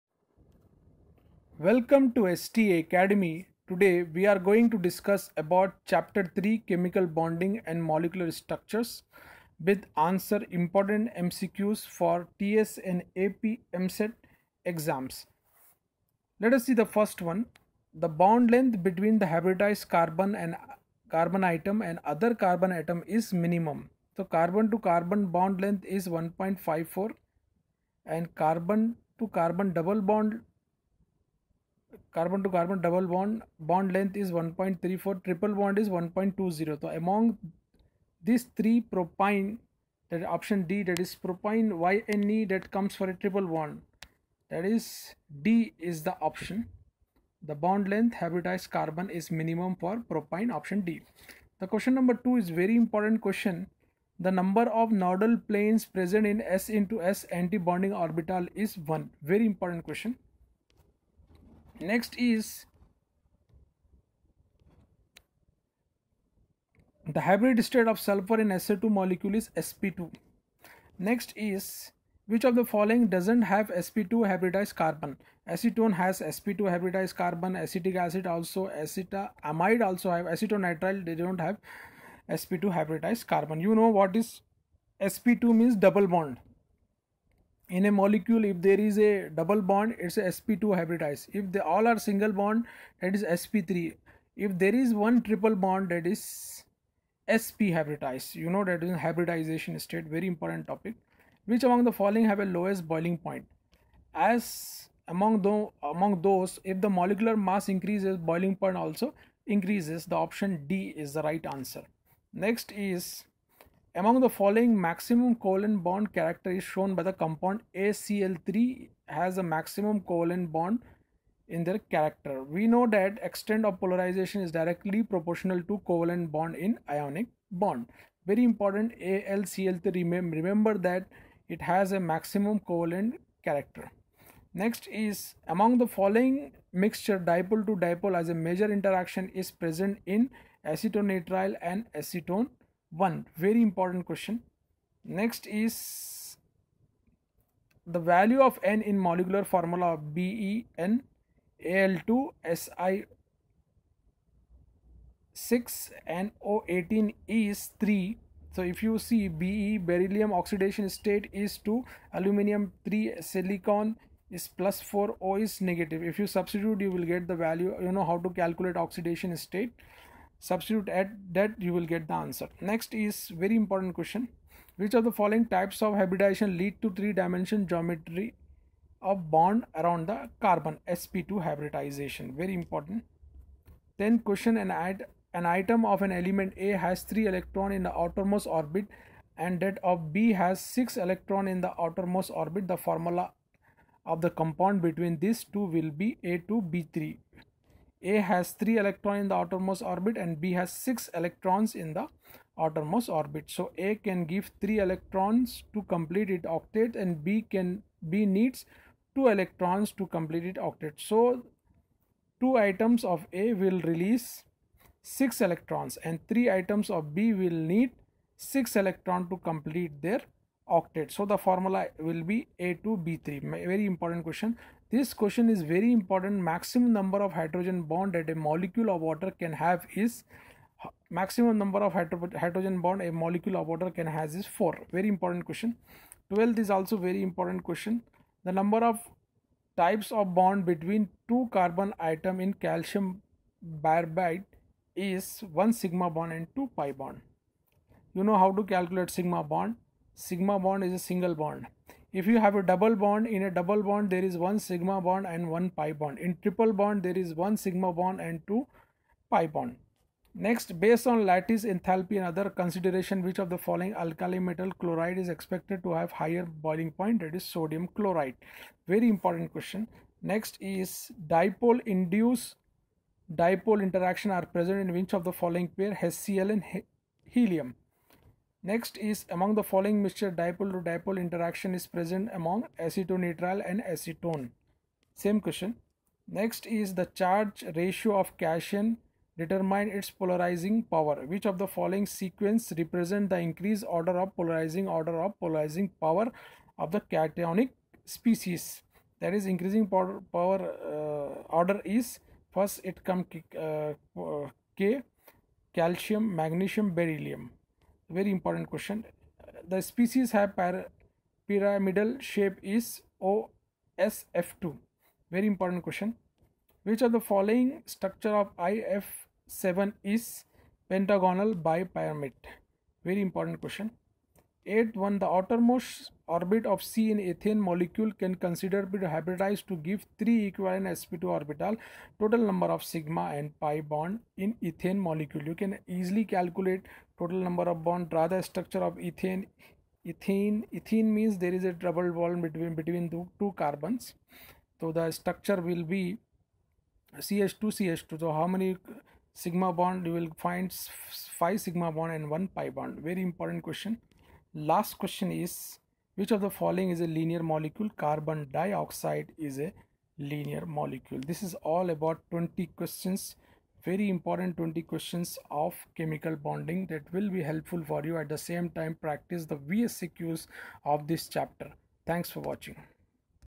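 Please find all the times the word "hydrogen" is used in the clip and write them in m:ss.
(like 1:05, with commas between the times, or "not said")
3:47, 3:51.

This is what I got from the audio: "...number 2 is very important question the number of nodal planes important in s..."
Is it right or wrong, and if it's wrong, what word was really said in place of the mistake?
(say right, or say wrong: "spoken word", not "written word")
wrong: "present", not "important".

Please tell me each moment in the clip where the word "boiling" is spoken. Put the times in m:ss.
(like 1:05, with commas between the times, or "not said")
1:42, 1:48, 4:26.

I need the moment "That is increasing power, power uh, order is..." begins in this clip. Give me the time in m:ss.
4:59.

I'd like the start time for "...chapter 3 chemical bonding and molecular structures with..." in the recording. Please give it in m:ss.
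0:05.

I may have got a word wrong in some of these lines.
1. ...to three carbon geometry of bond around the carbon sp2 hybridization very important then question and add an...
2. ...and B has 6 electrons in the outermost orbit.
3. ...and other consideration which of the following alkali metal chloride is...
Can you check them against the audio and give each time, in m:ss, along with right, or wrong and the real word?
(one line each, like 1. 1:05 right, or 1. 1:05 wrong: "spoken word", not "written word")
1. 2:56 wrong: "dimension", not "carbon"
2. 3:20 right
3. 4:22 right.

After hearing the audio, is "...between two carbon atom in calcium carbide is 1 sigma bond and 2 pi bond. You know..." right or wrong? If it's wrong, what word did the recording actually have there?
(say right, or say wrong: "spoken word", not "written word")
right.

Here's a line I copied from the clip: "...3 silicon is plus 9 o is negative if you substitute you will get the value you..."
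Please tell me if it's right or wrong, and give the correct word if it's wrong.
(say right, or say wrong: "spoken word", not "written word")
wrong: "4", not "9".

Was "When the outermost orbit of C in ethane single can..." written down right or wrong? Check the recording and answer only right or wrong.
wrong.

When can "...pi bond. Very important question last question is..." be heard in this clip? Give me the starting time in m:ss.
5:52.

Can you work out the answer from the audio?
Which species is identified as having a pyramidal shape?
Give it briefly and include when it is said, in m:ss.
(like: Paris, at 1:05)
OSF2, at 5:13.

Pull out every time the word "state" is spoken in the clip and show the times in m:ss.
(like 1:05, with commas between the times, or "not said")
1:07, 1:39, 2:40, 2:49.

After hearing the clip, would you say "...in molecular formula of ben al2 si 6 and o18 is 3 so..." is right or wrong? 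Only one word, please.
right.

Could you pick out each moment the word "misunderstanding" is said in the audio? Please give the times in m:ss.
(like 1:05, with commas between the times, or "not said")
not said.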